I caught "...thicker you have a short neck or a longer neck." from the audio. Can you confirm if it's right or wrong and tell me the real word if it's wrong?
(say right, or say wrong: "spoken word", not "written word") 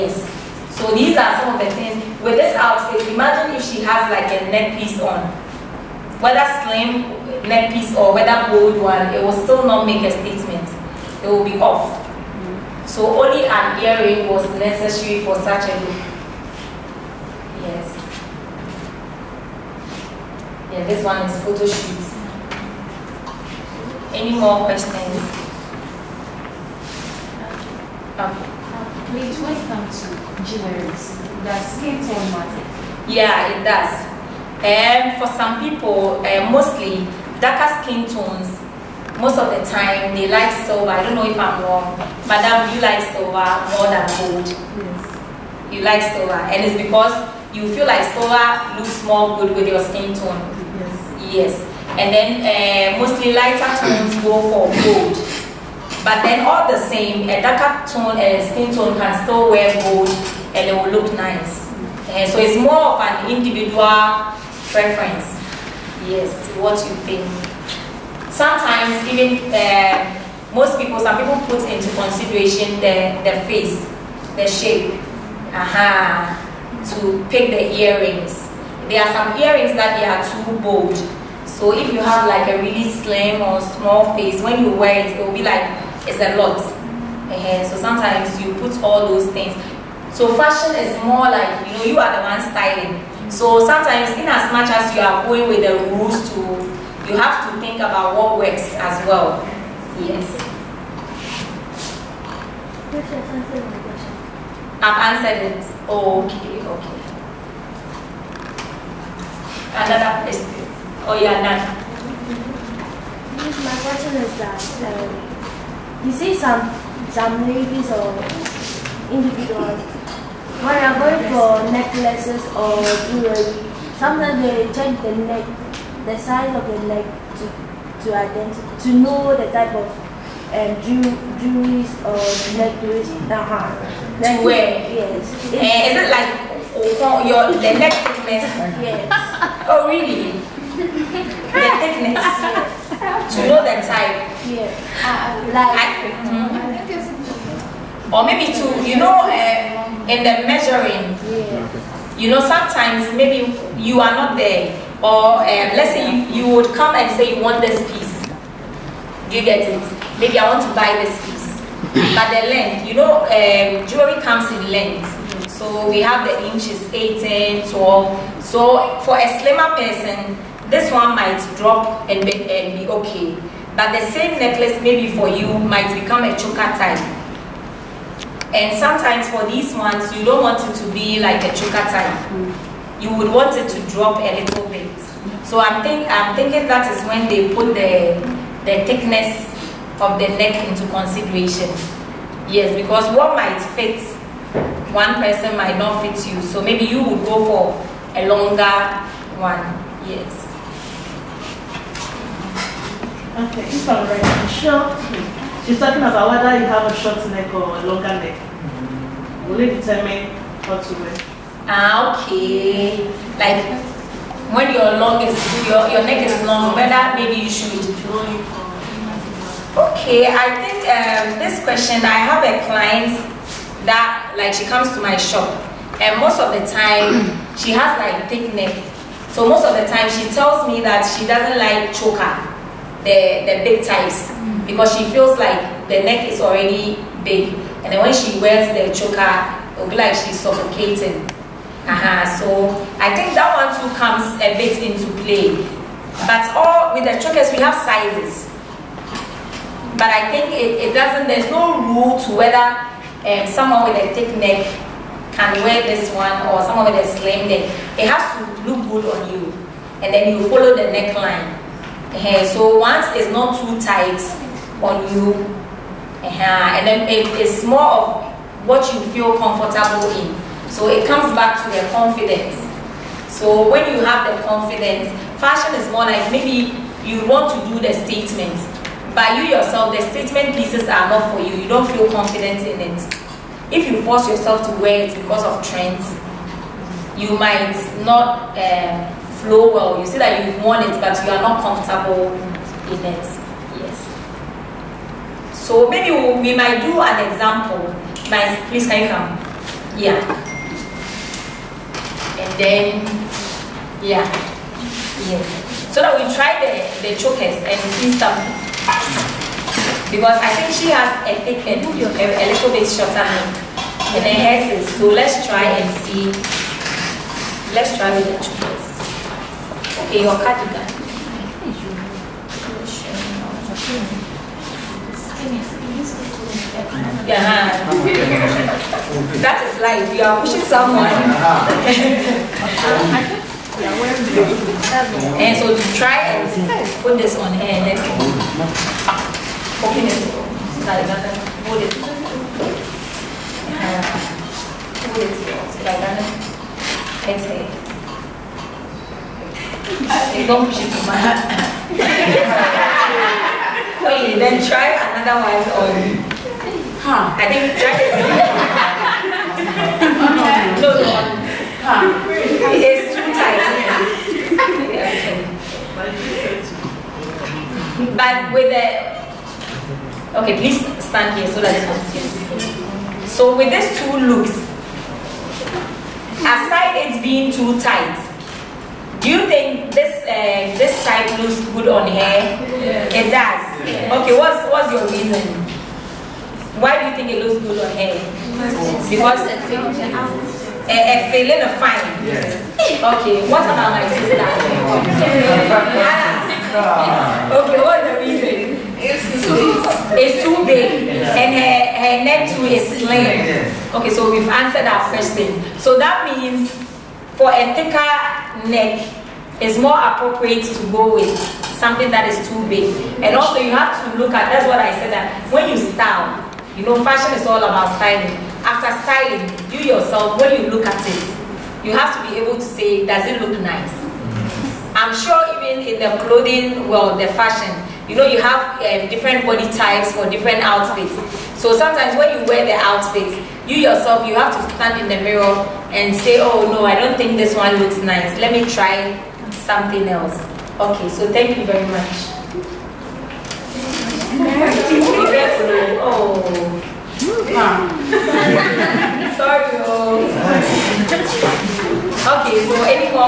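wrong: "whether", not "thicker".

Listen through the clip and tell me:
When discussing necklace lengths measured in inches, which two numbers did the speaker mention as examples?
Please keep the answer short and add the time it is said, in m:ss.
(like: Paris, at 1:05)
18, 12, at 2:46.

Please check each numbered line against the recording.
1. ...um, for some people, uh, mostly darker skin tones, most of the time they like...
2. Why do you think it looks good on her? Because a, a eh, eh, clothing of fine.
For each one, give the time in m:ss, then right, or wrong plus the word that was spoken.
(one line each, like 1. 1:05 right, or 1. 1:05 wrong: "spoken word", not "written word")
1. 0:35 right
2. 6:26 wrong: "feeling", not "clothing".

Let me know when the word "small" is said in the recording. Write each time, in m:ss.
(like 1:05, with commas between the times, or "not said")
1:23.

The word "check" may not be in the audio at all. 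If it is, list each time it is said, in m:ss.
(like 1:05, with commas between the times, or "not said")
2:04.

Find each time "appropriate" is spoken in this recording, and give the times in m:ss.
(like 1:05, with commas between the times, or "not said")
6:49.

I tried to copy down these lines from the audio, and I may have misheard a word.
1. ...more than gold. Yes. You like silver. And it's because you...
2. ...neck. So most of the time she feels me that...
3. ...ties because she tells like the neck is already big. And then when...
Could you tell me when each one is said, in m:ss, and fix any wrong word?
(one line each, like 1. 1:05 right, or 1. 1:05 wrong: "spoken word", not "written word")
1. 0:43 right
2. 3:48 wrong: "tells", not "feels"
3. 3:53 wrong: "feels", not "tells".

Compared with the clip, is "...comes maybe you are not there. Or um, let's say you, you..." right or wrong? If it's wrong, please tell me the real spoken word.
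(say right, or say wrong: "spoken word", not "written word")
wrong: "sometimes", not "comes".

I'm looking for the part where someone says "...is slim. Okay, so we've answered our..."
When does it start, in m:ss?
6:42.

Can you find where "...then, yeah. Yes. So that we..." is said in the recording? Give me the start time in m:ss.
5:02.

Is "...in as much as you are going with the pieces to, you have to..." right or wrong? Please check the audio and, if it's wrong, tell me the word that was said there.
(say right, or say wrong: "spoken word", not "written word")
wrong: "rules", not "pieces".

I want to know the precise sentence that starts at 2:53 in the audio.
But the same necklace maybe for you might become a choker type.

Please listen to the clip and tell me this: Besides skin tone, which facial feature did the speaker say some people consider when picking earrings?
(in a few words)
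The shape.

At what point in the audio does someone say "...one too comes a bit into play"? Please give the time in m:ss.
4:03.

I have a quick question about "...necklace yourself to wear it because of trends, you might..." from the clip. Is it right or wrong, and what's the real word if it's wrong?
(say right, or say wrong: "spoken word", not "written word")
wrong: "force", not "necklace".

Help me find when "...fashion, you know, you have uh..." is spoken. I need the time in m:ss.
7:07.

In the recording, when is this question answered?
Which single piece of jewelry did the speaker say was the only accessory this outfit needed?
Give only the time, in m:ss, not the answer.
0:13.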